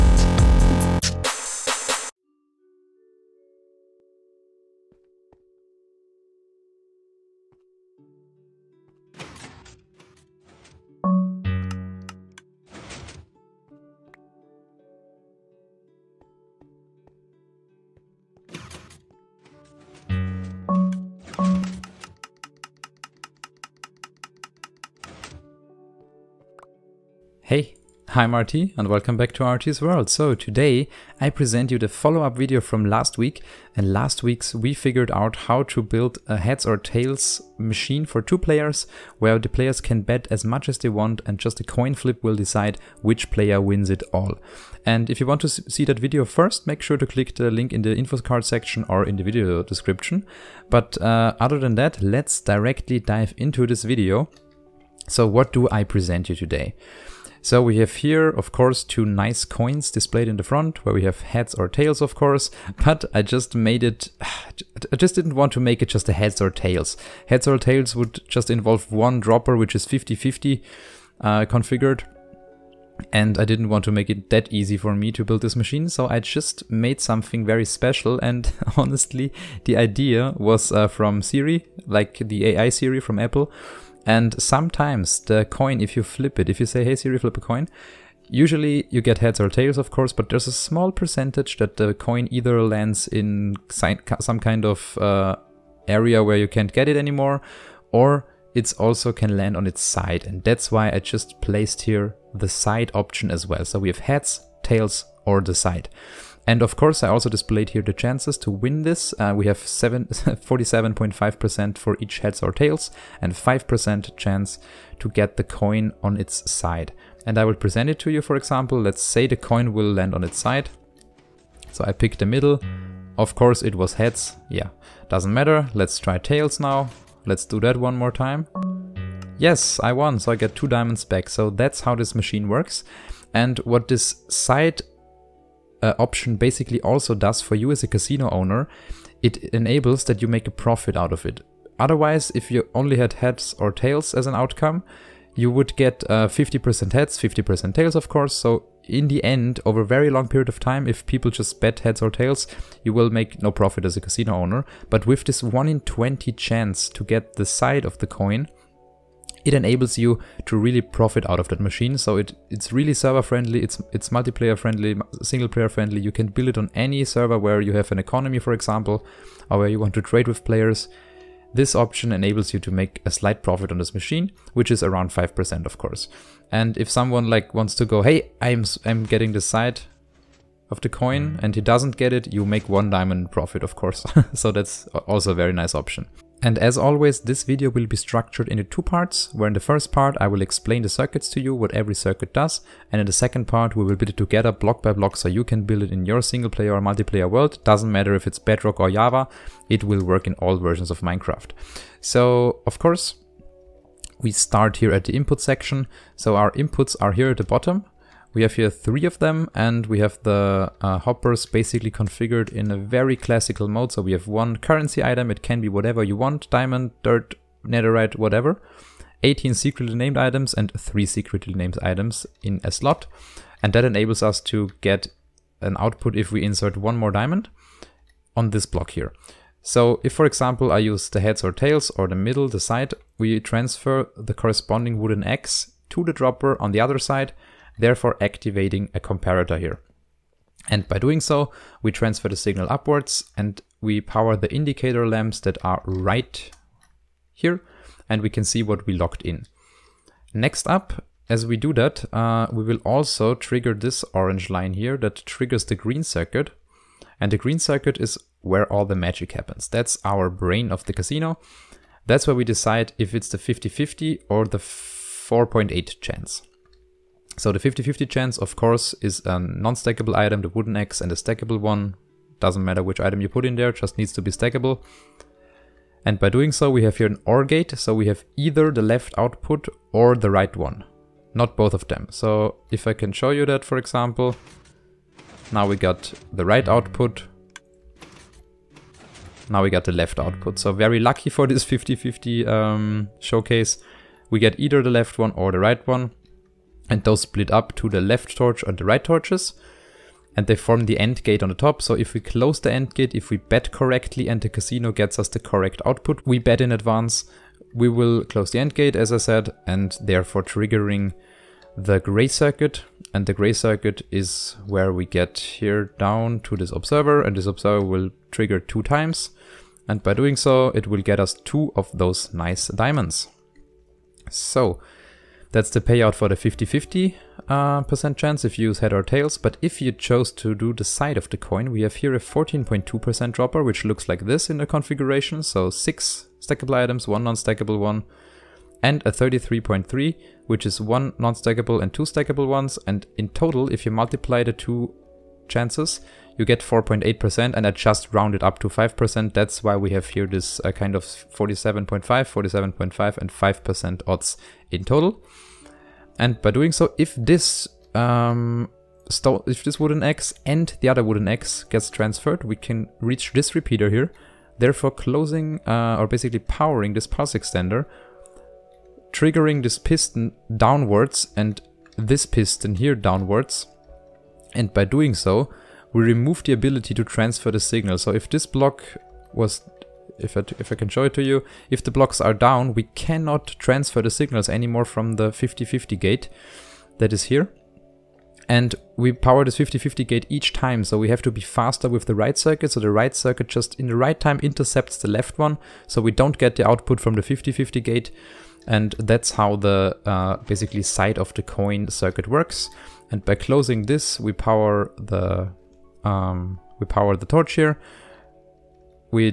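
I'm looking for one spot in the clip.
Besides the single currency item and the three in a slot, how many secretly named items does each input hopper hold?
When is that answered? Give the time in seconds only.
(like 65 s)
219 s.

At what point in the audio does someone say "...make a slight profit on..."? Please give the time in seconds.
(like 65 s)
172 s.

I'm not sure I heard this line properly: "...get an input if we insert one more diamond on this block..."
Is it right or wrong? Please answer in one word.
wrong.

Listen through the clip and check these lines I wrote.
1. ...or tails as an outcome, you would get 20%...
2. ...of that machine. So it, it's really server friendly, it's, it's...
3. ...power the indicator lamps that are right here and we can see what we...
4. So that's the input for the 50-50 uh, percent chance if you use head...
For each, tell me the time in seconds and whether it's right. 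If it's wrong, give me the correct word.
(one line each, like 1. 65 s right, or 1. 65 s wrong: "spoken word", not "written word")
1. 143 s wrong: "50", not "20"
2. 161 s right
3. 244 s right
4. 324 s wrong: "payout", not "input".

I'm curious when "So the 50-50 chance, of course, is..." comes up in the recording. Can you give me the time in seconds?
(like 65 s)
267 s.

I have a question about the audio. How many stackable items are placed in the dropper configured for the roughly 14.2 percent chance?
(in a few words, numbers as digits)
6.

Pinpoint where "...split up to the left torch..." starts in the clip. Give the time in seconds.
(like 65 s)
297 s.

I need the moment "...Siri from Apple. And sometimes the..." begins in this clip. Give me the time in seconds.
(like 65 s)
82 s.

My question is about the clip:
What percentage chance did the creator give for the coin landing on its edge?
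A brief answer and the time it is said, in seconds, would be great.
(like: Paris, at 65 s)
5%, at 113 s.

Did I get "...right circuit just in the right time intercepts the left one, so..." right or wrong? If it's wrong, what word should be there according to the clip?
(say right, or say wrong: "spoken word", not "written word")
right.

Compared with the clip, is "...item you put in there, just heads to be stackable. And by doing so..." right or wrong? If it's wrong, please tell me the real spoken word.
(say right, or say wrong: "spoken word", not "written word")
wrong: "needs", not "heads".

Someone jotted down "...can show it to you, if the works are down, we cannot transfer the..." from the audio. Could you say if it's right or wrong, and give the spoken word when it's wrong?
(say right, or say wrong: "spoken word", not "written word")
wrong: "blocks", not "works".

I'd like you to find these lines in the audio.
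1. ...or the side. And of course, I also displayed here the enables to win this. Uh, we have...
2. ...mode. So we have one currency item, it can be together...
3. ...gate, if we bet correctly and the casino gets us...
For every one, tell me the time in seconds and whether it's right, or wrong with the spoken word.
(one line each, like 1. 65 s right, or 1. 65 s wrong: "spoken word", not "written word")
1. 105 s wrong: "chances", not "enables"
2. 213 s wrong: "whatever", not "together"
3. 302 s right.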